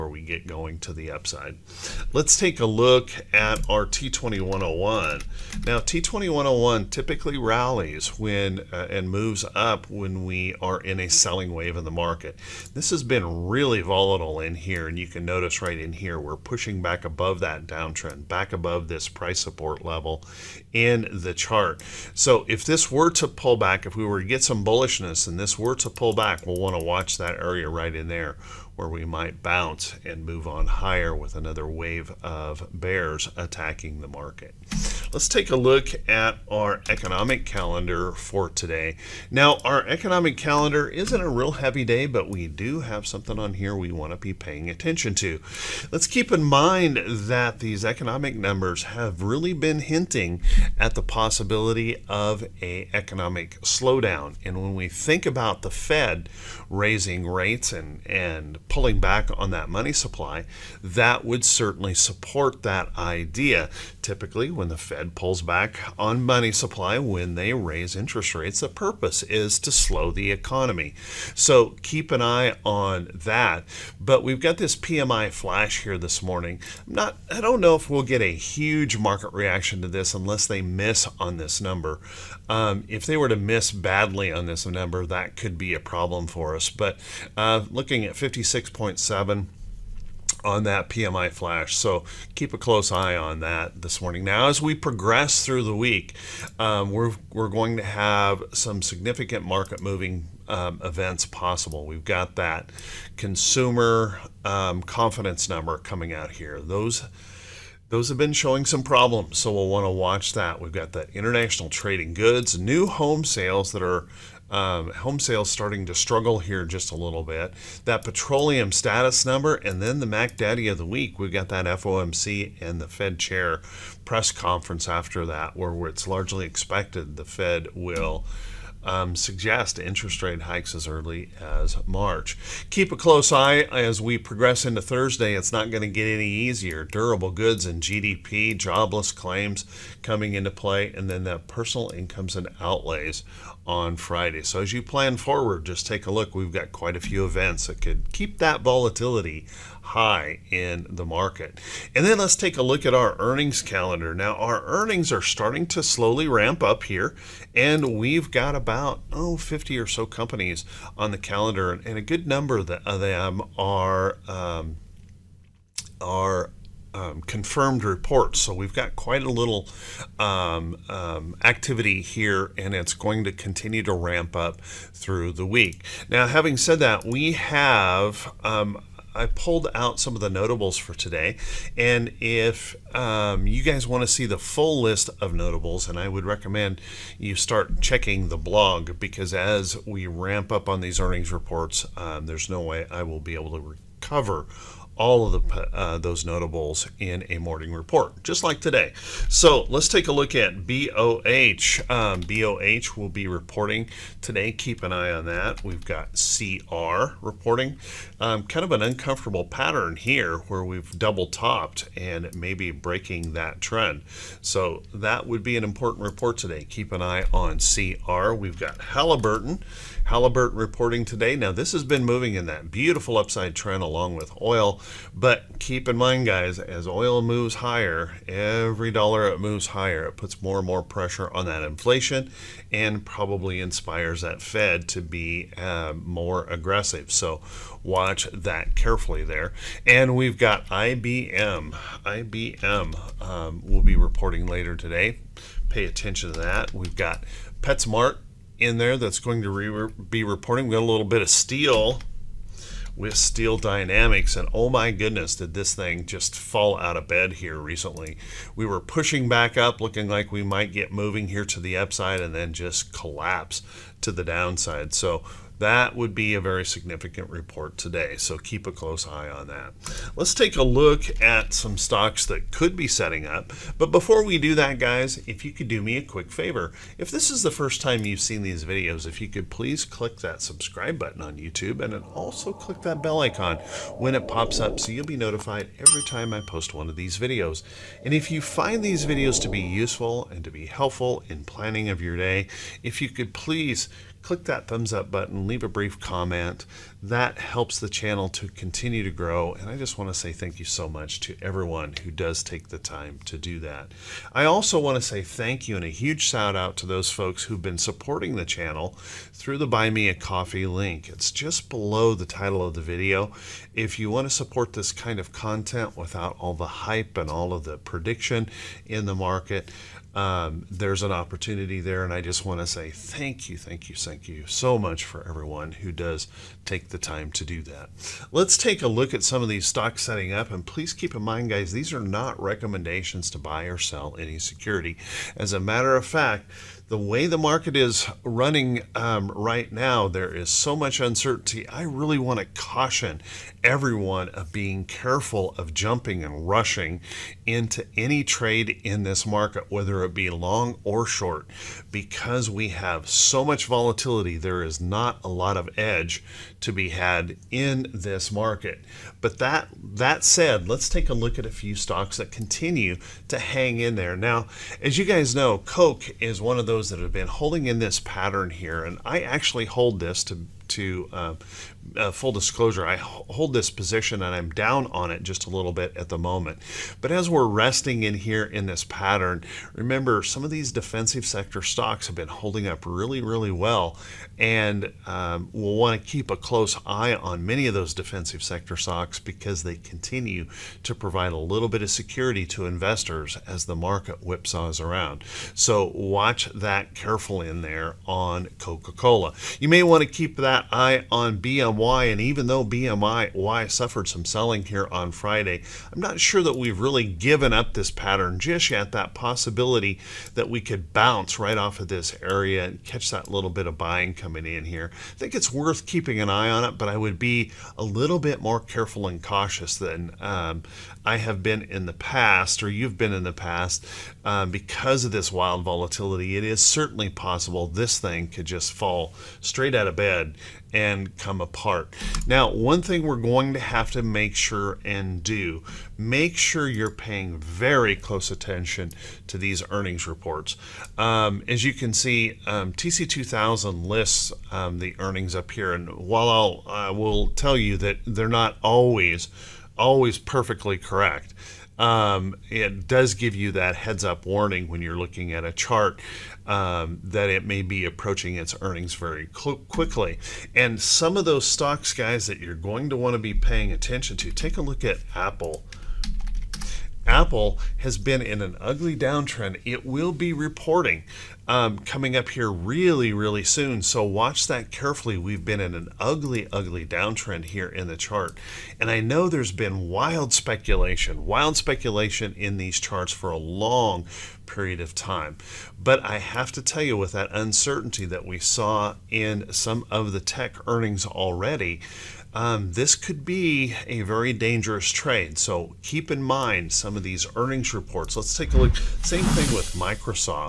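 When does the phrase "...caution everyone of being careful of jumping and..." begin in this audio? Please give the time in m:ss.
5:42.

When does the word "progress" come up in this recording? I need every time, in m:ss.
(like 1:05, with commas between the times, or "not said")
1:34, 2:14.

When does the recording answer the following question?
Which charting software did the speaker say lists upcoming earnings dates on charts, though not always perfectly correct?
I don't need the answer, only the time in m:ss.
7:22.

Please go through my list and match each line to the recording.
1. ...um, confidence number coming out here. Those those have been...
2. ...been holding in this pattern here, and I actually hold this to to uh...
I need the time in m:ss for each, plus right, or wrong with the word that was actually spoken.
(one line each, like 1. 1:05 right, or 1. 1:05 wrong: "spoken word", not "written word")
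1. 1:44 right
2. 6:07 right.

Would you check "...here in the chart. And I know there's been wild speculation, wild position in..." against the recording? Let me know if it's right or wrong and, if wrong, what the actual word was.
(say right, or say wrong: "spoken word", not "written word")
wrong: "speculation", not "position".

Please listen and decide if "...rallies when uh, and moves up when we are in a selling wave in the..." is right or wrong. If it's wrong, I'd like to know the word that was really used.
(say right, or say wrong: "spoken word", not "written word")
right.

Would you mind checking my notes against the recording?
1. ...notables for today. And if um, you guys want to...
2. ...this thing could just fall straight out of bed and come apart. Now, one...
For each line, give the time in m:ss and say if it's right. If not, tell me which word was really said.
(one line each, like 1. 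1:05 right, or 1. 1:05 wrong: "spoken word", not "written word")
1. 3:00 right
2. 7:07 right.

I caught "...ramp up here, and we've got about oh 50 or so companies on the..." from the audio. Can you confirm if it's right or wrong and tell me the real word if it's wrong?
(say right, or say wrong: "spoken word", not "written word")
right.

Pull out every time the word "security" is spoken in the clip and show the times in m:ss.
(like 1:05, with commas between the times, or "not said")
5:34, 6:31.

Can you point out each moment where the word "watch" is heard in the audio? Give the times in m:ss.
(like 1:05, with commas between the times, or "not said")
0:26, 1:49, 3:57, 6:35, 7:54.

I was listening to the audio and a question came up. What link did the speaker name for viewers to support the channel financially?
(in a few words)
Buy Me a Coffee.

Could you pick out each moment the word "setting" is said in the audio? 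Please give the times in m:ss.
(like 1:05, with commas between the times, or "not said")
4:32, 5:30.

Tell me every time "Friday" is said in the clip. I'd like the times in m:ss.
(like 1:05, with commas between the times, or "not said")
2:23, 6:45.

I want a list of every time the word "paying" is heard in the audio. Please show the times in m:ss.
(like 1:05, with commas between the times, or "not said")
0:44, 7:16, 7:43.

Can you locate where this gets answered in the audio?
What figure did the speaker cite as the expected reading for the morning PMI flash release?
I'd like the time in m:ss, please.
1:28.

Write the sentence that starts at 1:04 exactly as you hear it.
Typically, when the Fed Fed pulls back on money supply when they raise interest rates, the purpose is to slow the economy.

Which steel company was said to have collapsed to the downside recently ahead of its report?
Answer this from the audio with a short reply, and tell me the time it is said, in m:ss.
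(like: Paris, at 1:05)
Steel Dynamics, at 4:13.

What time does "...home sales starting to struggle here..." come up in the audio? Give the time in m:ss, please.
1:54.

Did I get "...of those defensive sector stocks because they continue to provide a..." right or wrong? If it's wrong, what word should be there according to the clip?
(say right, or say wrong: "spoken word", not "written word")
right.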